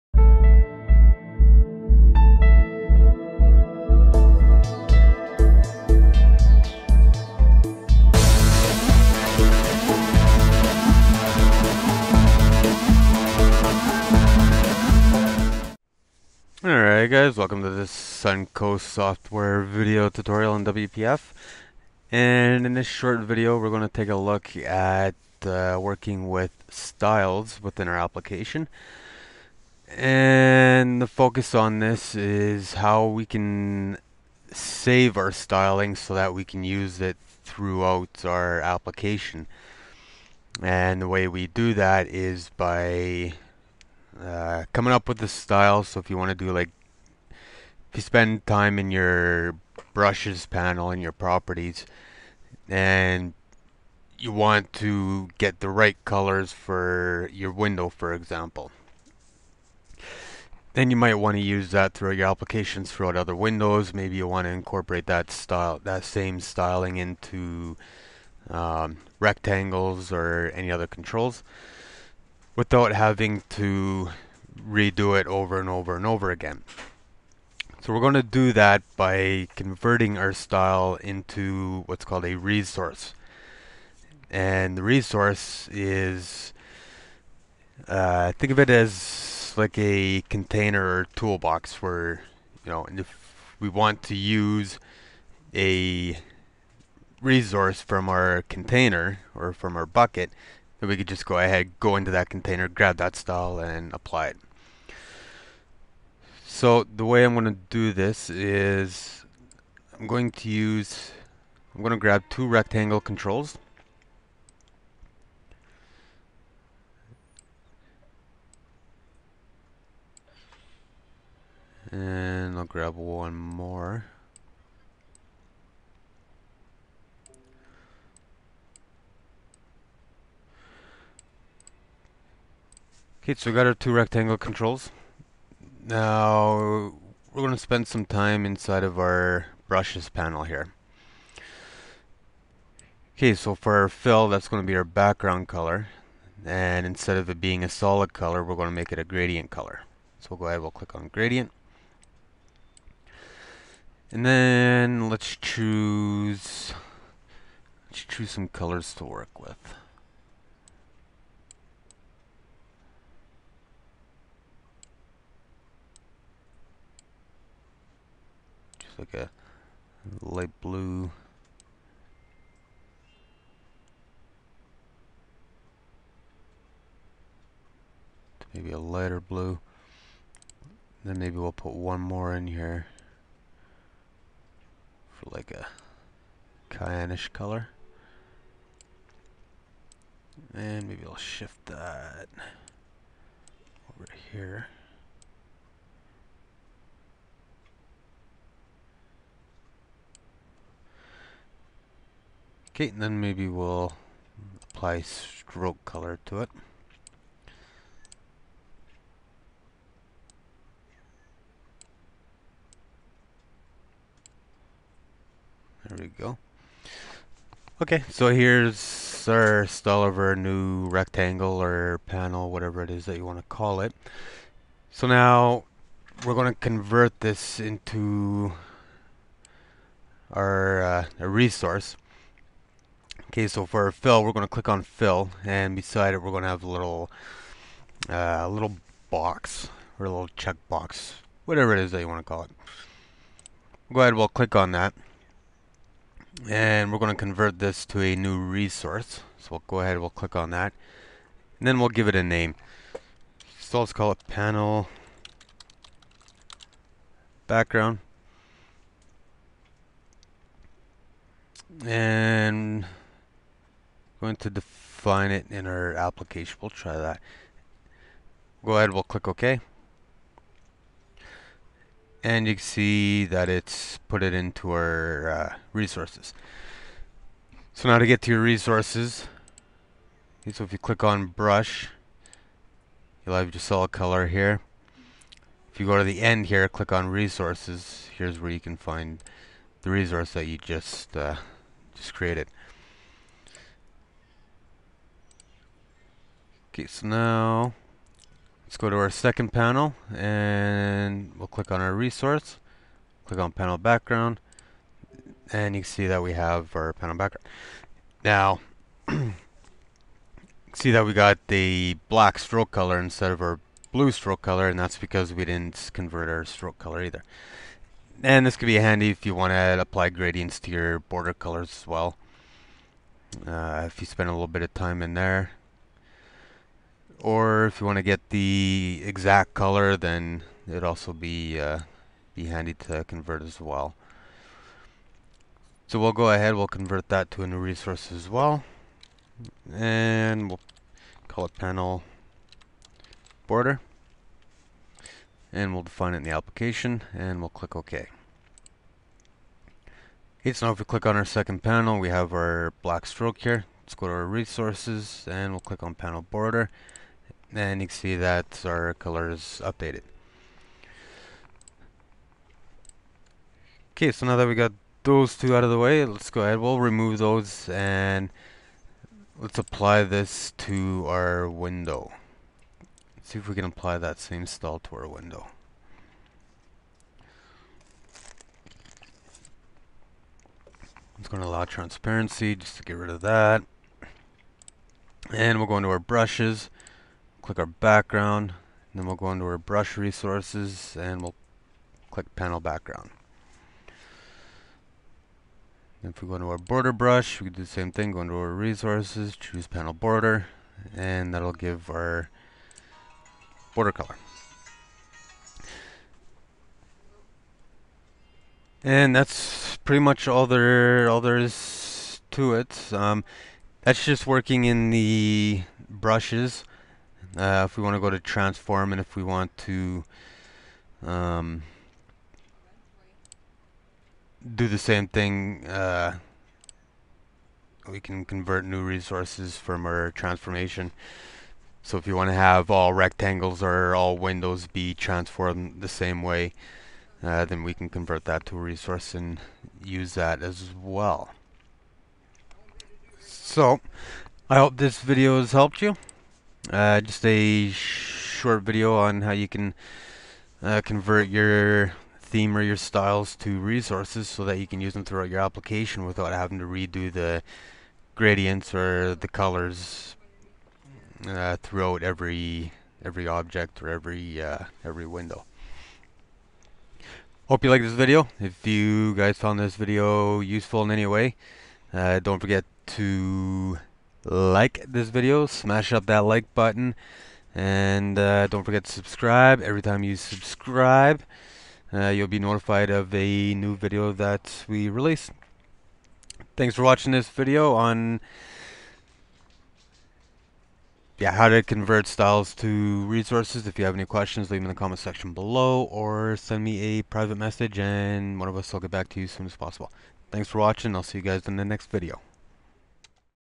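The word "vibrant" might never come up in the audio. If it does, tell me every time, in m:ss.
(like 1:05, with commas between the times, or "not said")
not said.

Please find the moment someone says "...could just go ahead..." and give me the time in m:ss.
1:40.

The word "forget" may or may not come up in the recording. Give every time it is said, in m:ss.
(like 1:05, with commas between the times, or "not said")
7:52, 7:58.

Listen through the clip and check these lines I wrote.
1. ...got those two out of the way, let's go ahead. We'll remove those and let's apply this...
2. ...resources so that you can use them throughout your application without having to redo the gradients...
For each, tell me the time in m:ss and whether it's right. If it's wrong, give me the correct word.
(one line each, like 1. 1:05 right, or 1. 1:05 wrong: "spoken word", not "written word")
1. 6:04 right
2. 7:33 right.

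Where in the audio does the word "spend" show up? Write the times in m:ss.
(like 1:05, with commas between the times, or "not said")
0:48, 2:17, 5:24.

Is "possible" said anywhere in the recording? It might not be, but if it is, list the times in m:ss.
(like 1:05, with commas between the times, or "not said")
8:19.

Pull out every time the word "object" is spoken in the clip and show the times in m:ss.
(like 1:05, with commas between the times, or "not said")
7:43.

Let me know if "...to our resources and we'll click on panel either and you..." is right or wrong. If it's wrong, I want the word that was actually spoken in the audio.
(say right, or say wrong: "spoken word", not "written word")
wrong: "border", not "either".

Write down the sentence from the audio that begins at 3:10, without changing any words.
And maybe I'll shift that over here.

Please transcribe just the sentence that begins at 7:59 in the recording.
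Every time you subscribe, uh, you'll be notified of a new video that we release.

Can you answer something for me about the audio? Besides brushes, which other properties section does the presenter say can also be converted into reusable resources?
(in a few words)
Transform.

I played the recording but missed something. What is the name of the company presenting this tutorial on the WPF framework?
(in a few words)
Suncoast software.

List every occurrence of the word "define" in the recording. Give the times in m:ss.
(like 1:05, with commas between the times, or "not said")
4:24, 5:45.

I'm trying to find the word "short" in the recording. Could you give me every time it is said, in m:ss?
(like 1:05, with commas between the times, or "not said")
0:22, 7:27.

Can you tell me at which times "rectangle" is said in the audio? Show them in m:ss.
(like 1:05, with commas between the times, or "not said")
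1:09, 1:52, 2:13, 3:40, 7:12.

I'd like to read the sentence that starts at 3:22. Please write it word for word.
and then maybe we'll apply stroke color to it.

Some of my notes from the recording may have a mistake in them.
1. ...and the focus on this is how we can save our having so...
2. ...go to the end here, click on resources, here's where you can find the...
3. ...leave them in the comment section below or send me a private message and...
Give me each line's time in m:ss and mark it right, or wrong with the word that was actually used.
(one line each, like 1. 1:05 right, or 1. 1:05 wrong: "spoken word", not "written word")
1. 0:29 wrong: "styling", not "having"
2. 4:45 right
3. 8:14 right.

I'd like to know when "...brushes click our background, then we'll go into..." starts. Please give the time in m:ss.
6:25.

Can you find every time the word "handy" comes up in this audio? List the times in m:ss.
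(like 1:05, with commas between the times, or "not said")
5:18, 5:32.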